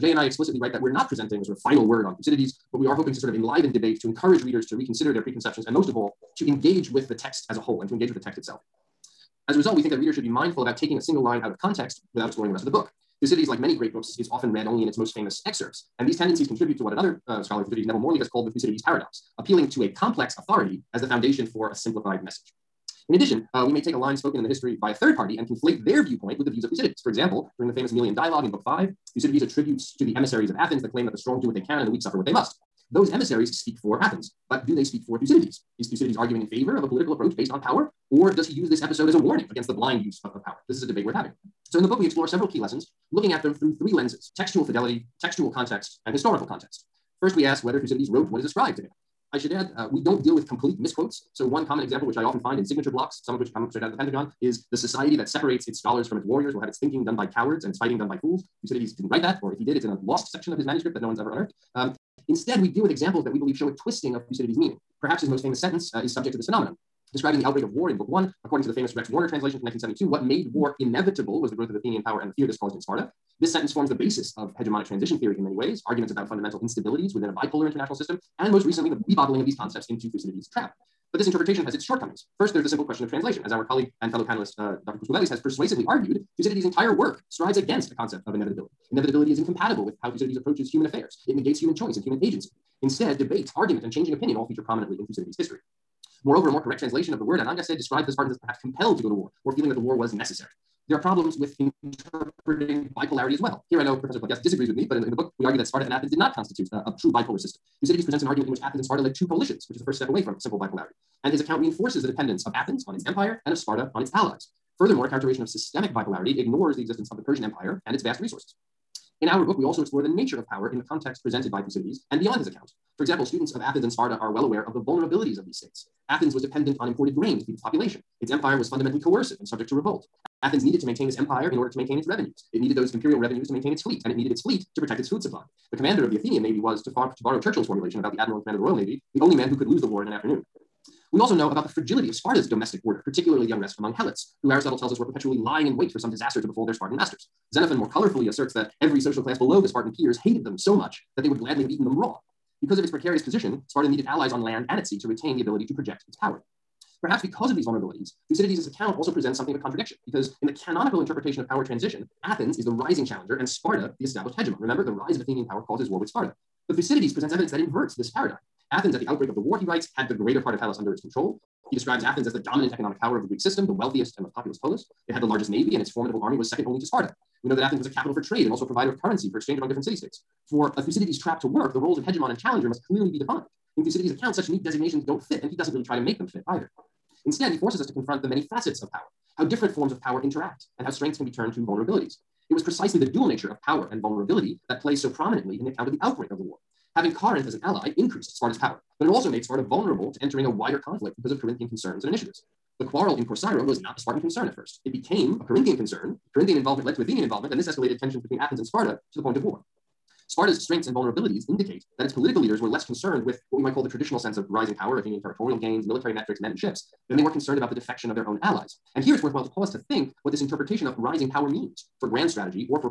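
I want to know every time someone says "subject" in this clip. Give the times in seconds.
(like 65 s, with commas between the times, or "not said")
66 s, 129 s.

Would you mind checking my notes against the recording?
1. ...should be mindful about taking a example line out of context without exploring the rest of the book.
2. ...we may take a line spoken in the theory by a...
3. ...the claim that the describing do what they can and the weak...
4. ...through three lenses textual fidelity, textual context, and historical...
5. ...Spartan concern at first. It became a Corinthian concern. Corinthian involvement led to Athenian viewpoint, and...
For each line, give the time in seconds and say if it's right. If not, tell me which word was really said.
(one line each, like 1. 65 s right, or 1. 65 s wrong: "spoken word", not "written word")
1. 10 s wrong: "single", not "example"
2. 23 s wrong: "history", not "theory"
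3. 30 s wrong: "strong", not "describing"
4. 43 s right
5. 203 s wrong: "involvement", not "viewpoint".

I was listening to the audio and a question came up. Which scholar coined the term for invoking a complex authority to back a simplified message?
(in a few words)
Neville Morley.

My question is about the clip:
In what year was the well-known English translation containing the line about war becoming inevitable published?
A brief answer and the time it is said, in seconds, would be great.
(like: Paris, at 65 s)
1972, at 69 s.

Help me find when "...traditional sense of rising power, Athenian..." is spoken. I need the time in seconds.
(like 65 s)
213 s.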